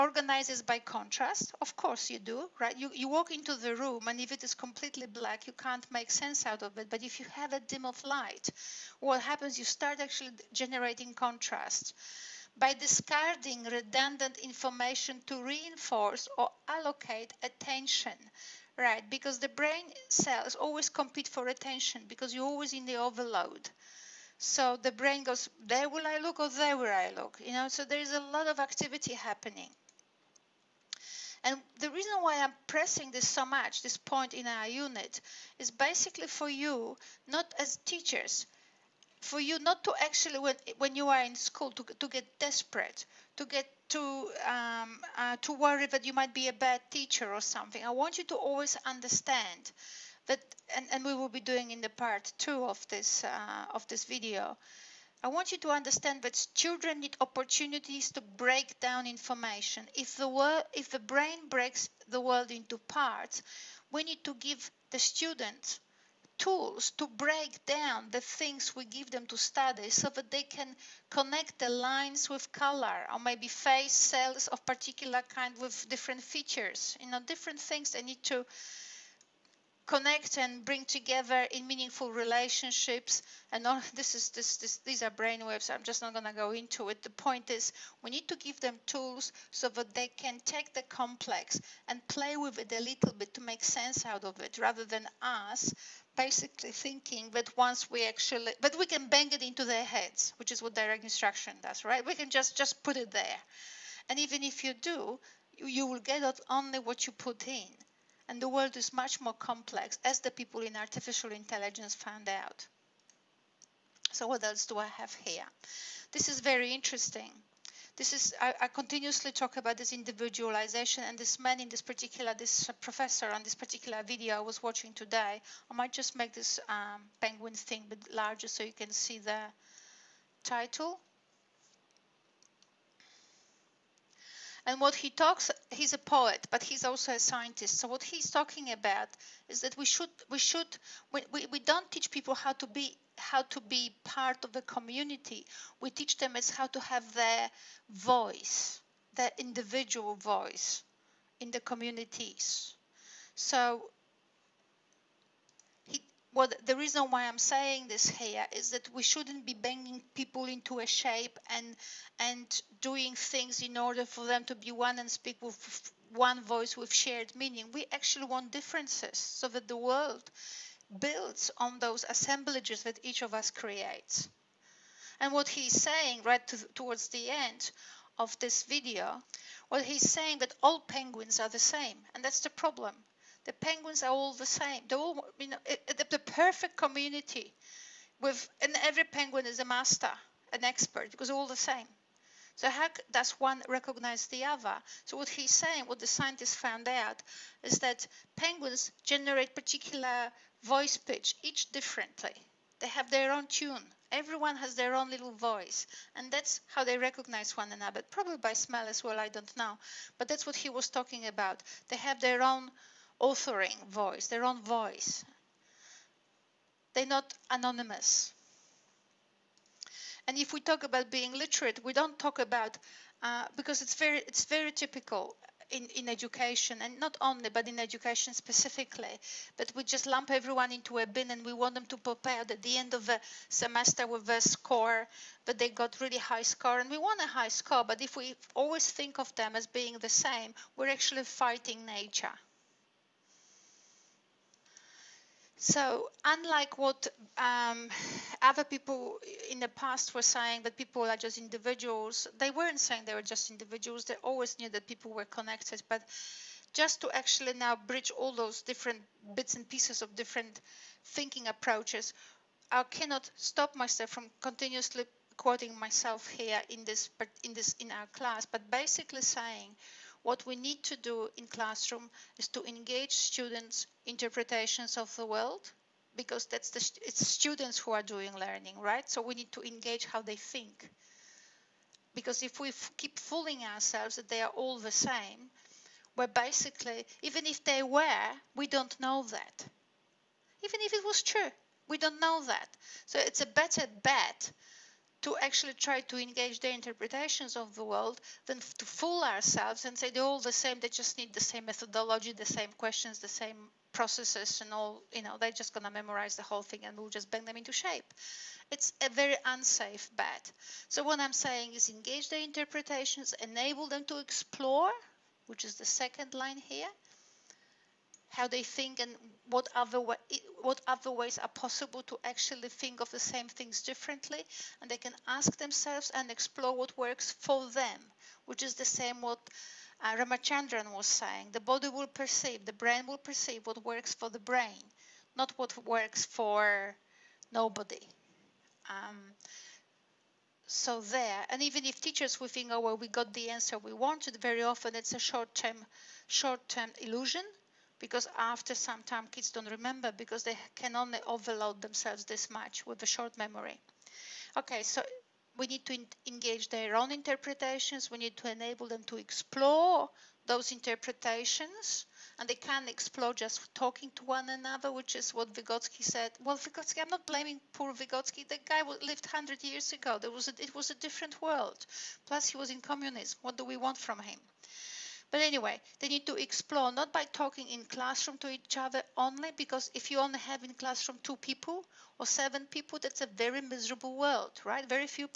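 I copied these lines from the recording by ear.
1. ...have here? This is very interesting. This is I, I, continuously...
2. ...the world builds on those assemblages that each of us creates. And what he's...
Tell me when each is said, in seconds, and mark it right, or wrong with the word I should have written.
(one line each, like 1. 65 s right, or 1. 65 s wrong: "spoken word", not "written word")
1. 114 s right
2. 169 s right.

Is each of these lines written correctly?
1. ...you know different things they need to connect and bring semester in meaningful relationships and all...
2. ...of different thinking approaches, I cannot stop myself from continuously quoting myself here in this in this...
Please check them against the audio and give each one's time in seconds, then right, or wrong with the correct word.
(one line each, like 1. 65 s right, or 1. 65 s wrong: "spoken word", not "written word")
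1. 77 s wrong: "together", not "semester"
2. 260 s right.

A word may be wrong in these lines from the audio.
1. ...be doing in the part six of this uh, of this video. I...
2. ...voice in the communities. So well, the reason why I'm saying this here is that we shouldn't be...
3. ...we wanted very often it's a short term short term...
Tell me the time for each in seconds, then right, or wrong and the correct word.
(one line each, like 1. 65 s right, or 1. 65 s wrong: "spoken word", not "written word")
1. 51 s wrong: "two", not "six"
2. 150 s right
3. 343 s right.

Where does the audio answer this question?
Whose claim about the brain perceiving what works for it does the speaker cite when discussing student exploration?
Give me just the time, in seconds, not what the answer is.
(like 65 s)
330 s.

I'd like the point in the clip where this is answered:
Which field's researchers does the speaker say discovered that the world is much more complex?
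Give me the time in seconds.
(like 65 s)
110 s.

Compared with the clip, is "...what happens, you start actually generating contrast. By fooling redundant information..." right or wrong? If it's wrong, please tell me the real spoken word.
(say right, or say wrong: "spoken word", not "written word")
wrong: "discarding", not "fooling".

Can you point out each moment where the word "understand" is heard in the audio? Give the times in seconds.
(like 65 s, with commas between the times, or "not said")
48 s, 55 s.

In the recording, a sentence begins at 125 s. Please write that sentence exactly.
I might just make this um, penguin thing a bit larger so you can see the title.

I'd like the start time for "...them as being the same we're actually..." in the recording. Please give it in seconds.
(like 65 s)
239 s.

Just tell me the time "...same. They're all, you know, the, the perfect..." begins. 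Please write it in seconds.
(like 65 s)
184 s.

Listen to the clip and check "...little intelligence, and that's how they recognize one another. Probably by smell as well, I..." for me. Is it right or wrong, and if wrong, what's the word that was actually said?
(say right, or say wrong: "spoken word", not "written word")
wrong: "voice", not "intelligence".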